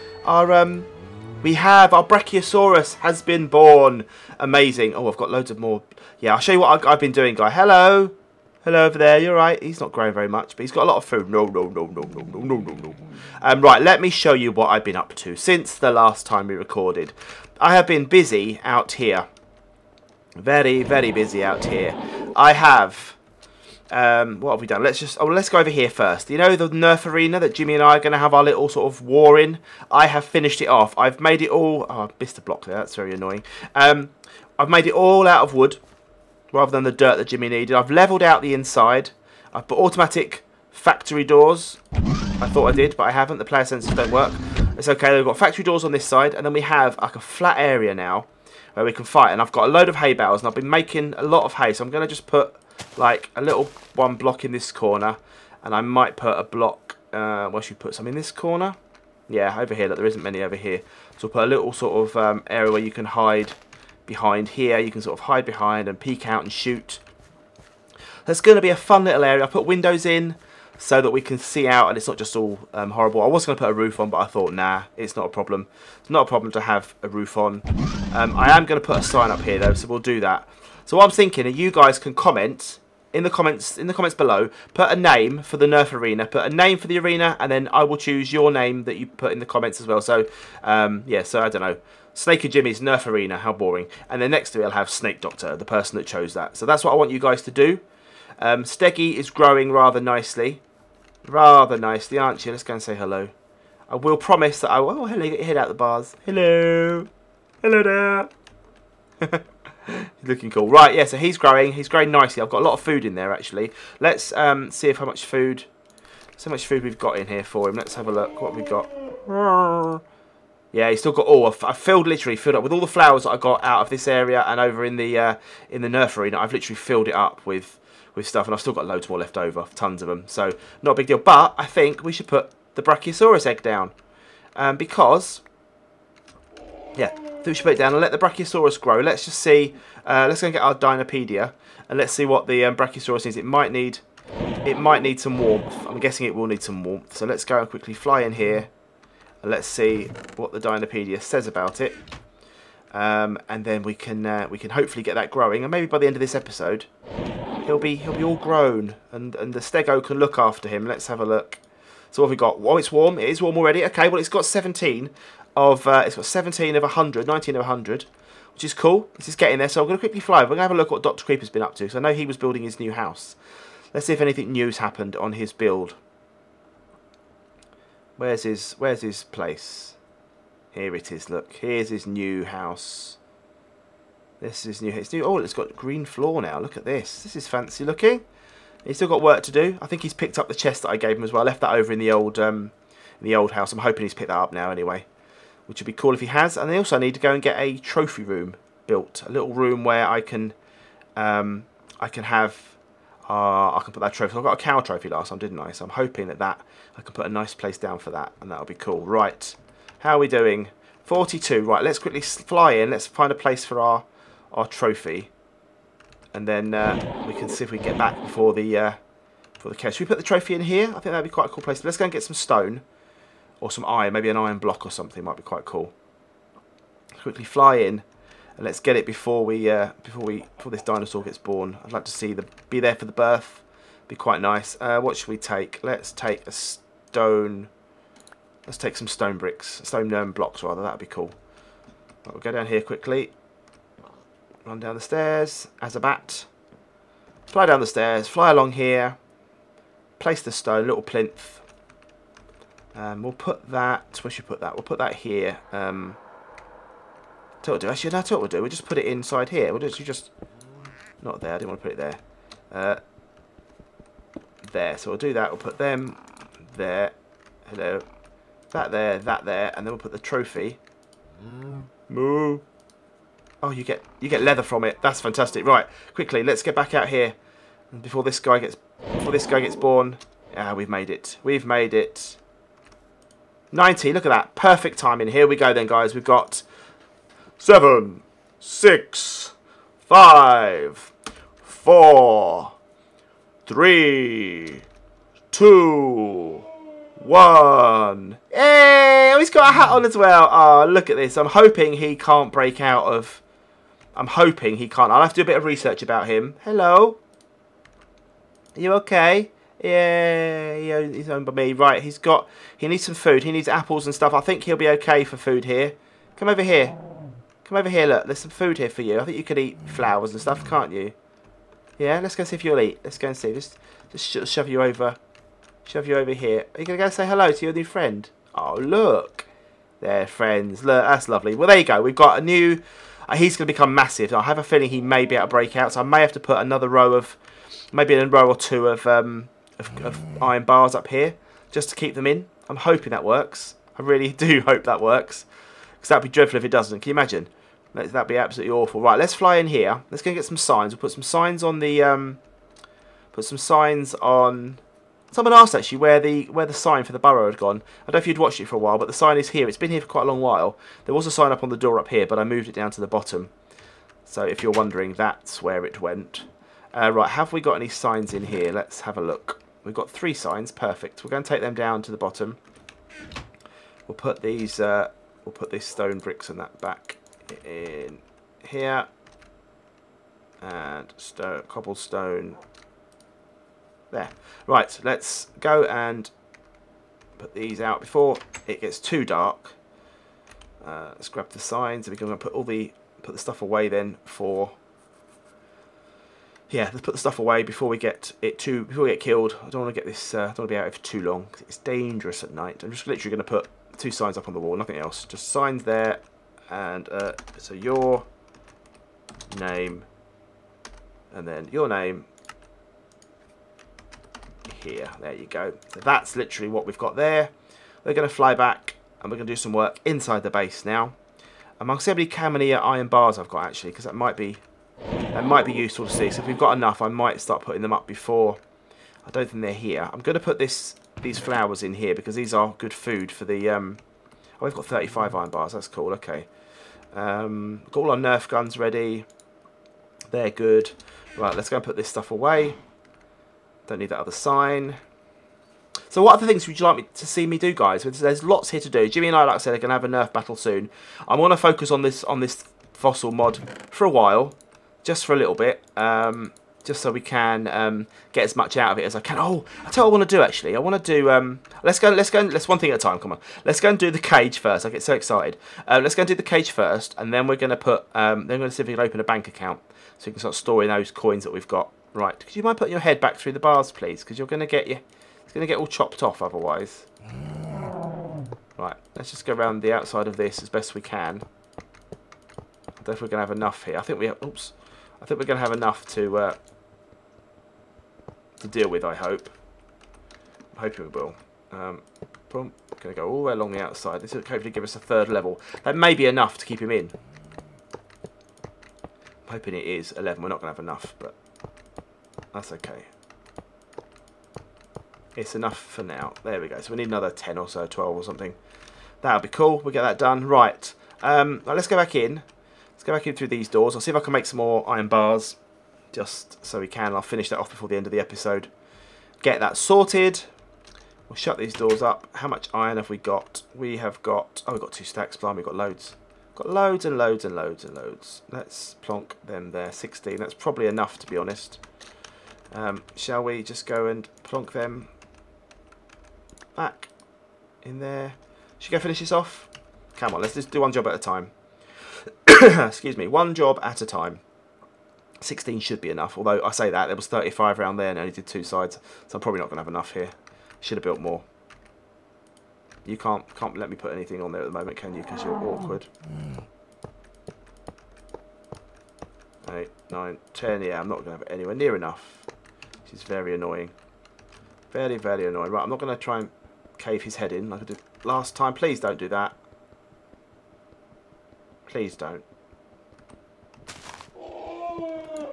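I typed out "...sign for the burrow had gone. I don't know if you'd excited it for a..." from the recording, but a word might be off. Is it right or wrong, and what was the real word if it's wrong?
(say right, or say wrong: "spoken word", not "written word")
wrong: "watched", not "excited".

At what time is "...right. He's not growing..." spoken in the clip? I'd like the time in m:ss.
0:09.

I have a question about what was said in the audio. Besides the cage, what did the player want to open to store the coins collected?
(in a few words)
bank account.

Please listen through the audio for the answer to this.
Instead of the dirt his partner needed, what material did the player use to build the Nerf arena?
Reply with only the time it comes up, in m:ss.
0:34.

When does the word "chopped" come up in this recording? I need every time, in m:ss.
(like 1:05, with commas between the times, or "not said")
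7:55.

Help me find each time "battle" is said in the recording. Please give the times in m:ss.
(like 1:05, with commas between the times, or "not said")
7:30.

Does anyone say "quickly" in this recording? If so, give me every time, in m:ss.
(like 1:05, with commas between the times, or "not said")
2:27, 2:49, 3:31, 3:47, 4:02, 4:36.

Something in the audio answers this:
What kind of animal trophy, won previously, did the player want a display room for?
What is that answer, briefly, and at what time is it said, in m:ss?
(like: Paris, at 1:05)
cow, at 3:24.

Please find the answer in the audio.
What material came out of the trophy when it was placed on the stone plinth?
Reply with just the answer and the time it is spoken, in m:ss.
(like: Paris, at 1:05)
leather, at 4:34.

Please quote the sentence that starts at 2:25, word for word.
I'm guessing it will need some warmth.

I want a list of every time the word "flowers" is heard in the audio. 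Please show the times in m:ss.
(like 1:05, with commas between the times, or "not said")
2:02, 5:19, 7:11.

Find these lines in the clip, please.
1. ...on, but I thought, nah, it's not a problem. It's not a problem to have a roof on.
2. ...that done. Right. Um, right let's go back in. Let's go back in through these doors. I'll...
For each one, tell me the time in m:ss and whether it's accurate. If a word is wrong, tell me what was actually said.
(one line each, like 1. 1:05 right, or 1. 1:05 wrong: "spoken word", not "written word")
1. 1:13 right
2. 8:30 right.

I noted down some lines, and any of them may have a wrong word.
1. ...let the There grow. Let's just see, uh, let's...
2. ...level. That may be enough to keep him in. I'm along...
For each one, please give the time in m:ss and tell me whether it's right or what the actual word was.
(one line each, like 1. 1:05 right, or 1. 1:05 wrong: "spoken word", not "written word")
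1. 2:18 wrong: "Brachiosaurus", not "There"
2. 8:15 wrong: "hoping", not "along".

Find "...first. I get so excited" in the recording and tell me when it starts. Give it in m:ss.
7:44.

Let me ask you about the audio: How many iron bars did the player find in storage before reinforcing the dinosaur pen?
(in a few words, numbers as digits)
35.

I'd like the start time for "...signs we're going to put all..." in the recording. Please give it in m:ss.
6:31.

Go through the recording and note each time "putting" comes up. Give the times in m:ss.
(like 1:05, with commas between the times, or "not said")
7:07, 7:52.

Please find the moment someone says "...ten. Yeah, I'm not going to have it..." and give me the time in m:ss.
9:20.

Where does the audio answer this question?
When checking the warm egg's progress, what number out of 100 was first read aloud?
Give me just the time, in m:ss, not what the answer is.
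2:46.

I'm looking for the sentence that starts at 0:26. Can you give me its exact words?
You know the Nerf arena that Jimmy and I are going to have our little sort of war in.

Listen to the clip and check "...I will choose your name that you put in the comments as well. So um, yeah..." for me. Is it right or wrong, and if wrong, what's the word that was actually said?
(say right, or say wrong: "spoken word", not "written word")
right.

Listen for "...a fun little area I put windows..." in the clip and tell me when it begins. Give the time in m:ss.
1:08.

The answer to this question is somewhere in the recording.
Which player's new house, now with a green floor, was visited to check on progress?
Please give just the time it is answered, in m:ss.
2:51.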